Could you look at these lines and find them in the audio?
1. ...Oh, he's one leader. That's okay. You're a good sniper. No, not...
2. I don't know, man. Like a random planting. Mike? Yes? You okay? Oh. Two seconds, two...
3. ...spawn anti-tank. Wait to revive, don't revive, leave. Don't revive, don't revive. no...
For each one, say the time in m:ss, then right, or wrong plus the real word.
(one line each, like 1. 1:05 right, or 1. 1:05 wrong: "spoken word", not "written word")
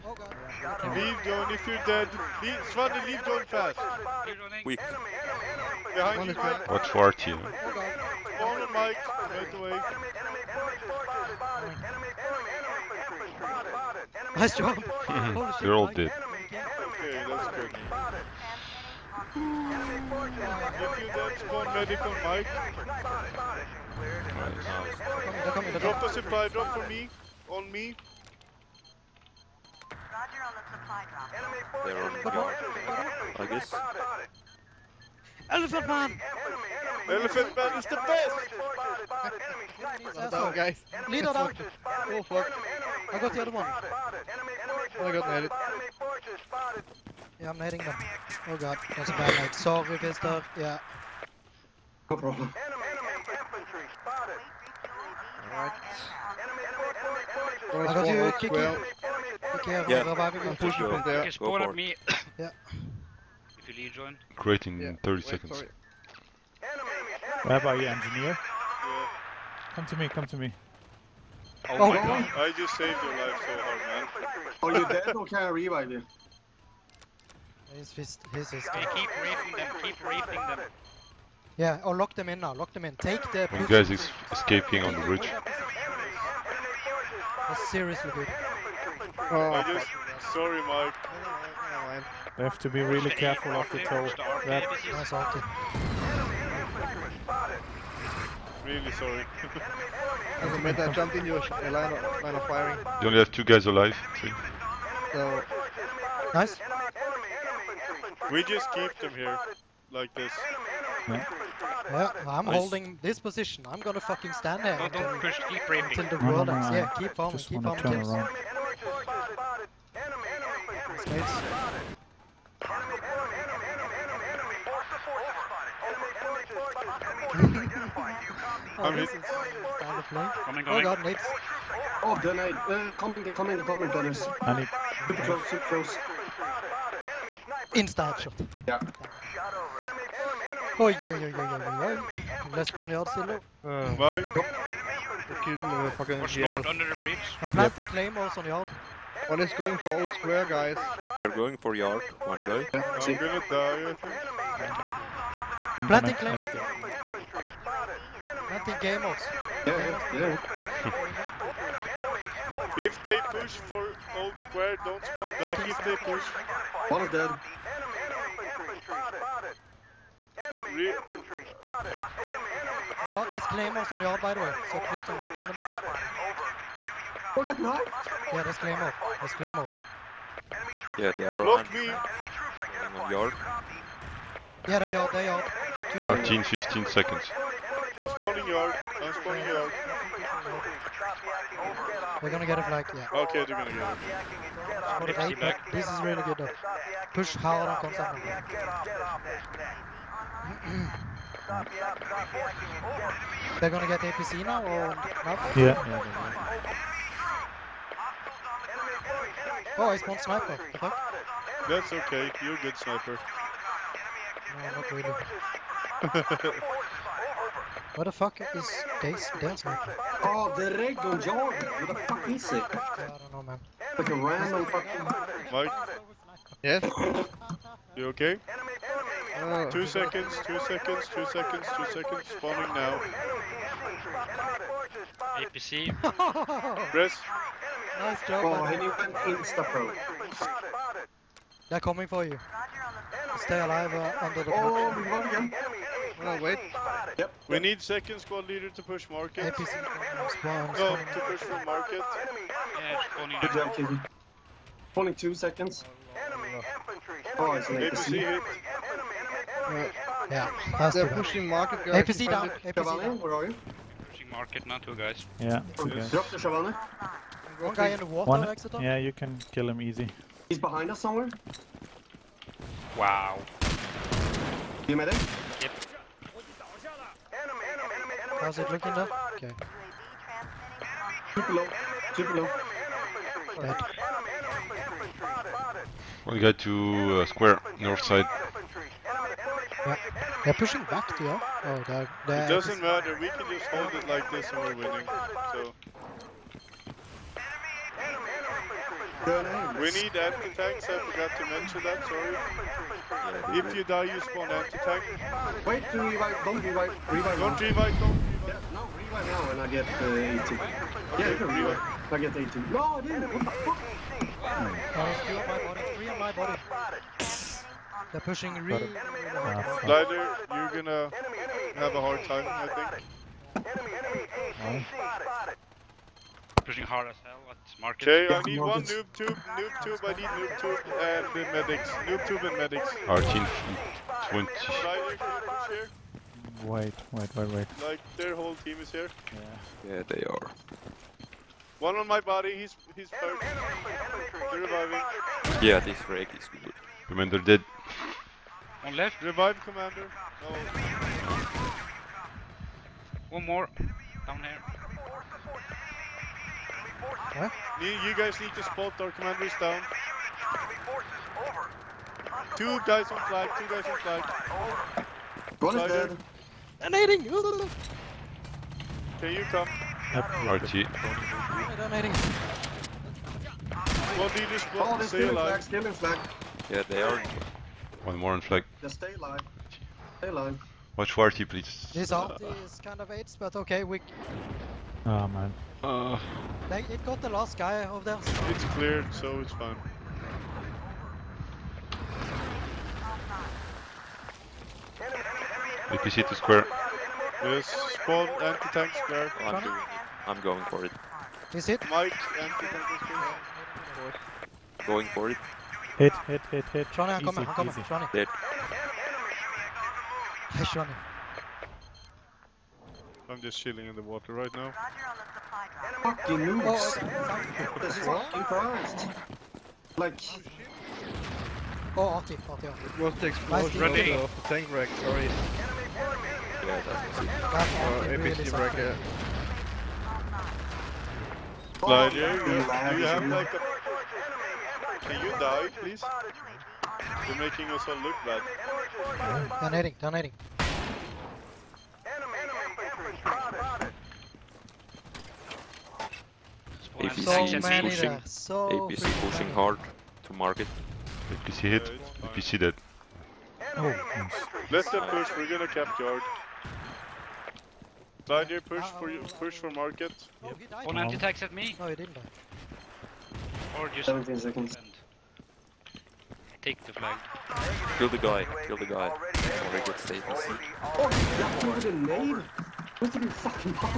1. 3:29 wrong: "sniper", not "leader"
2. 3:42 wrong: "fucking", not "planting"
3. 5:04 wrong: "revive", not "leave".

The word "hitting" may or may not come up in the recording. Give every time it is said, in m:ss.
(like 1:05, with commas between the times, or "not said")
0:47, 2:08.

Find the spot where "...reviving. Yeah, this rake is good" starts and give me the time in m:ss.
5:44.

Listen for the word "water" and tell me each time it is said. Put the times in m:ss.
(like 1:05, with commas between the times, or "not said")
4:28, 6:54.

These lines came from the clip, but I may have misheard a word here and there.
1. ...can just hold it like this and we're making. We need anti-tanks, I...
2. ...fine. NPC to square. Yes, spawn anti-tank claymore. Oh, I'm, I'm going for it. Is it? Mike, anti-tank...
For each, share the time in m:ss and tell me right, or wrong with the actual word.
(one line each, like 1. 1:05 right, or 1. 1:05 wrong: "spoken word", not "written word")
1. 4:53 wrong: "winning", not "making"
2. 6:29 wrong: "square", not "claymore".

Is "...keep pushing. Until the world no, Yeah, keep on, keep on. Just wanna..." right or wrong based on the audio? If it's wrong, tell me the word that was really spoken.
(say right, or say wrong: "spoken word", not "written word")
wrong: "raping", not "pushing".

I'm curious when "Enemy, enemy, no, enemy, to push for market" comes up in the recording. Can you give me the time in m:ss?
4:09.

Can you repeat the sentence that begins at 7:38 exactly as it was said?
Blind push for you, push for market.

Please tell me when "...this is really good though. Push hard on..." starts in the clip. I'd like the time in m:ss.
3:15.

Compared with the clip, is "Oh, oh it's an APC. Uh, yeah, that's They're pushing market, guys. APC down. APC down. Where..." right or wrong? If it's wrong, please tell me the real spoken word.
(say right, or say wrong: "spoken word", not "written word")
right.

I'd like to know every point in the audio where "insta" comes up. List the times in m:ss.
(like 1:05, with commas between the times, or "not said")
2:17, 3:59.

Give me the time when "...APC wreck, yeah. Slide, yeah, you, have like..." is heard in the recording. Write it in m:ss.
7:08.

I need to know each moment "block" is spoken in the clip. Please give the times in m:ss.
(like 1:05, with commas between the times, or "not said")
3:01, 6:14.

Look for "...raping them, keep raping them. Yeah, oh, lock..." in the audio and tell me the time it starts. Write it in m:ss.
1:19.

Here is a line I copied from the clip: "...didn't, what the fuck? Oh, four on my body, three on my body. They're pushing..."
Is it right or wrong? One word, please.
wrong.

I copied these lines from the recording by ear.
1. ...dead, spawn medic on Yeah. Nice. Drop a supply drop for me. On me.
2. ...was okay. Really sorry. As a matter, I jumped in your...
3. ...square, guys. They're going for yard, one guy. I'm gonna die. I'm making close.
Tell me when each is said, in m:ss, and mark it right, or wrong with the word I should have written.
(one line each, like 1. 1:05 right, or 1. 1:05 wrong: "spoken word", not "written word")
1. 0:21 wrong: "Mike", not "Yeah"
2. 1:34 right
3. 2:30 wrong: "planting", not "making".